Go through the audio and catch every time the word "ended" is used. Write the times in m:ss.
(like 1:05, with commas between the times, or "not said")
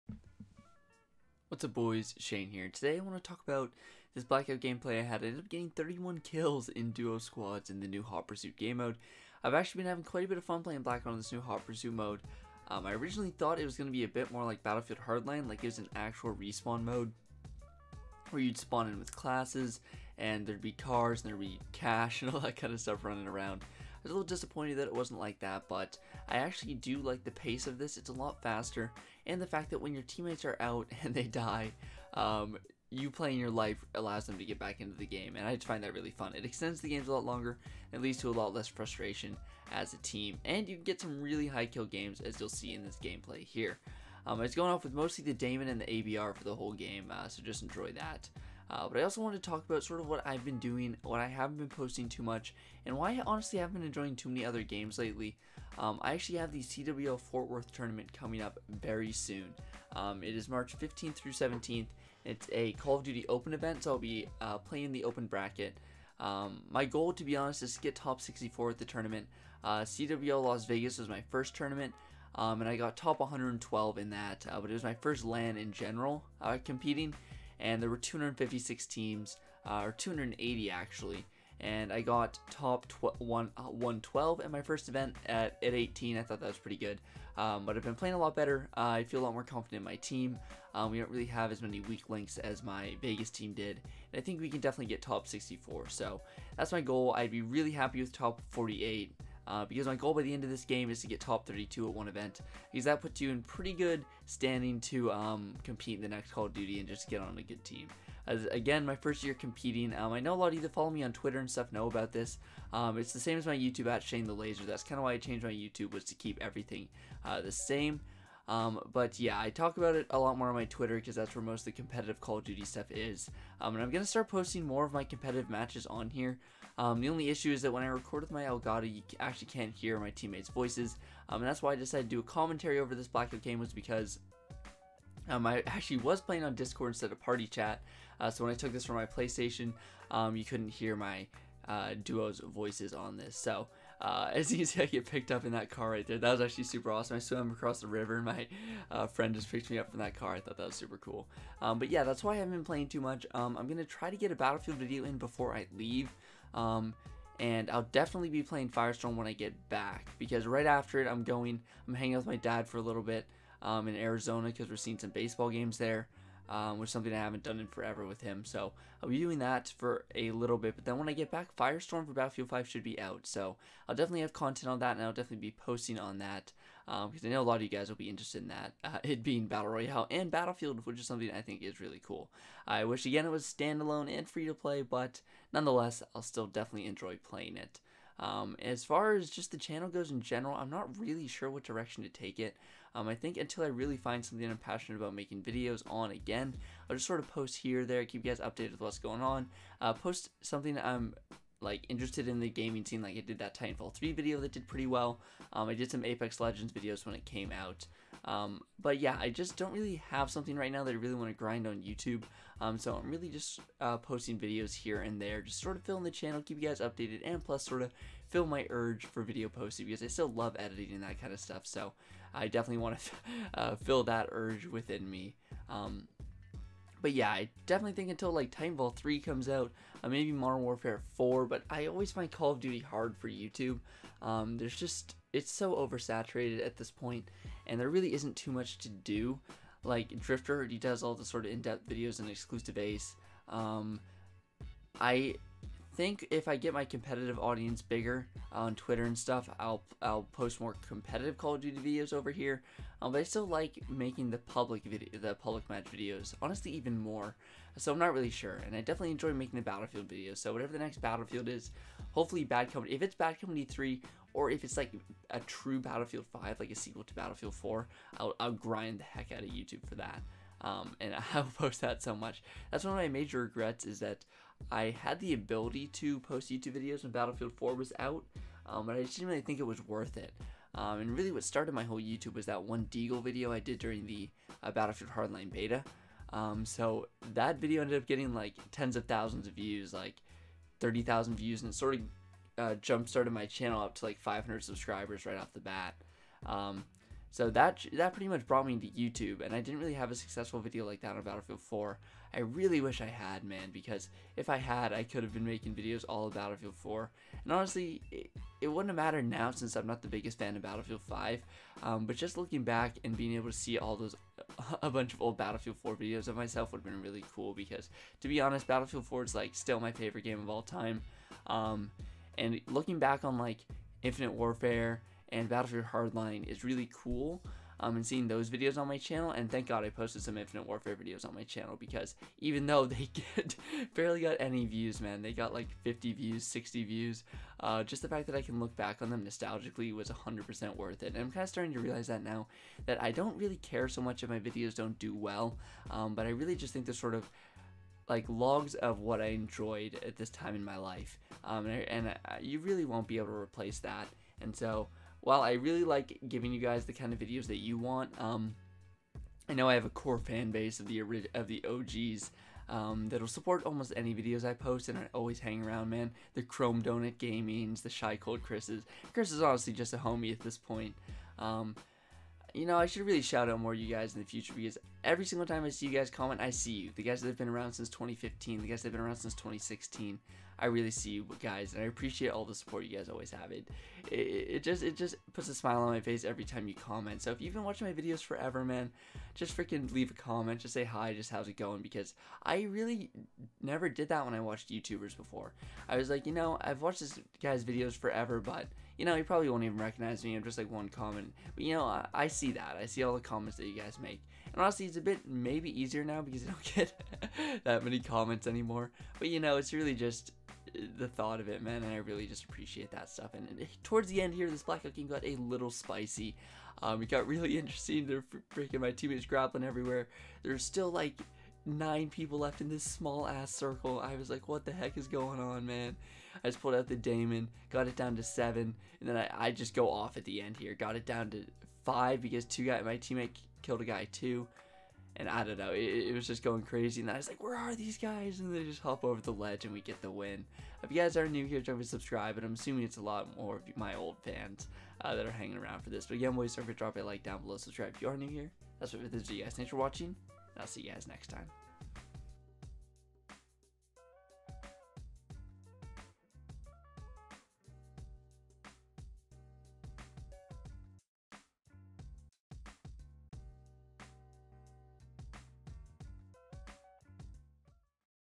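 0:05, 4:47.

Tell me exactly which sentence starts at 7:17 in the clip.
And I was like, where are these guys?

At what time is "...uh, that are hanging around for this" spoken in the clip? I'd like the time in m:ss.
7:25.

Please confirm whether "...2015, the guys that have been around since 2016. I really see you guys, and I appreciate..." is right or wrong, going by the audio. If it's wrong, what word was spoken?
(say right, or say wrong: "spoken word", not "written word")
right.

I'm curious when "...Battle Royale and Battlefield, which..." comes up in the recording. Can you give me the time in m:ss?
2:59.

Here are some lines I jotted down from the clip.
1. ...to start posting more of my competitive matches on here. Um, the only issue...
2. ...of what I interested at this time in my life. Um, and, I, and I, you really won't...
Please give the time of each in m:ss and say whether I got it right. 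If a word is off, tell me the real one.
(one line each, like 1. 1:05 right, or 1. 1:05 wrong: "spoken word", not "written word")
1. 2:04 right
2. 5:48 wrong: "enjoyed", not "interested".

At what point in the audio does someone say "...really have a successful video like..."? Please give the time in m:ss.
4:59.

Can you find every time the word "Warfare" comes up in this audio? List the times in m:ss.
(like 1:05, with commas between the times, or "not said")
3:50, 5:24, 5:30.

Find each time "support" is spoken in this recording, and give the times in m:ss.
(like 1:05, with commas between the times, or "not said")
6:03, 6:22.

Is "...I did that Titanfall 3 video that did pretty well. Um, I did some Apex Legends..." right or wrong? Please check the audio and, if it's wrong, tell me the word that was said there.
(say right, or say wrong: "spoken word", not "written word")
right.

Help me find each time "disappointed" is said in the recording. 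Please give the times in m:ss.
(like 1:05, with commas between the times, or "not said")
0:24.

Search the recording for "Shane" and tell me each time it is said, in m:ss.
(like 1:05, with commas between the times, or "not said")
0:02, 1:54.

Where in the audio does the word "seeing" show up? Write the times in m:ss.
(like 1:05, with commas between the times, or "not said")
2:44, 5:28.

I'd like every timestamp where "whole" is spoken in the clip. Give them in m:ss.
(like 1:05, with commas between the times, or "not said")
0:46, 4:41.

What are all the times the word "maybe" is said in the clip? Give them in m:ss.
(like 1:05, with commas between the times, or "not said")
3:50, 6:45.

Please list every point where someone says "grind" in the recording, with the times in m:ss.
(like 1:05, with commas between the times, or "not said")
3:31, 4:28.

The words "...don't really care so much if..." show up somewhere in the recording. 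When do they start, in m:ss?
5:43.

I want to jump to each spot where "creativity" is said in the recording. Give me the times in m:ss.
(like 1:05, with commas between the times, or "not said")
not said.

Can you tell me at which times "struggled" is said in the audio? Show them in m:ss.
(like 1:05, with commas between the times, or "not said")
not said.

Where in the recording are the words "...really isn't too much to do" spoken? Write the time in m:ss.
3:57.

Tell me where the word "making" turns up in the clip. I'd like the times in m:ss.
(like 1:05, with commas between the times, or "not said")
3:15, 4:13, 4:19, 5:05.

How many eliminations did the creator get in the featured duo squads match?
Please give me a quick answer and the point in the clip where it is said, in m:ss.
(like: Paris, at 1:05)
31, at 0:05.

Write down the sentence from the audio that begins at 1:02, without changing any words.
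It's a Call of Duty Open event, so I'll be uh, playing the open bracket.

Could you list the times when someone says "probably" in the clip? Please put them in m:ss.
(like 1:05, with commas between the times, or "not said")
6:39.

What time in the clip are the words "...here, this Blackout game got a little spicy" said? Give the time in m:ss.
6:54.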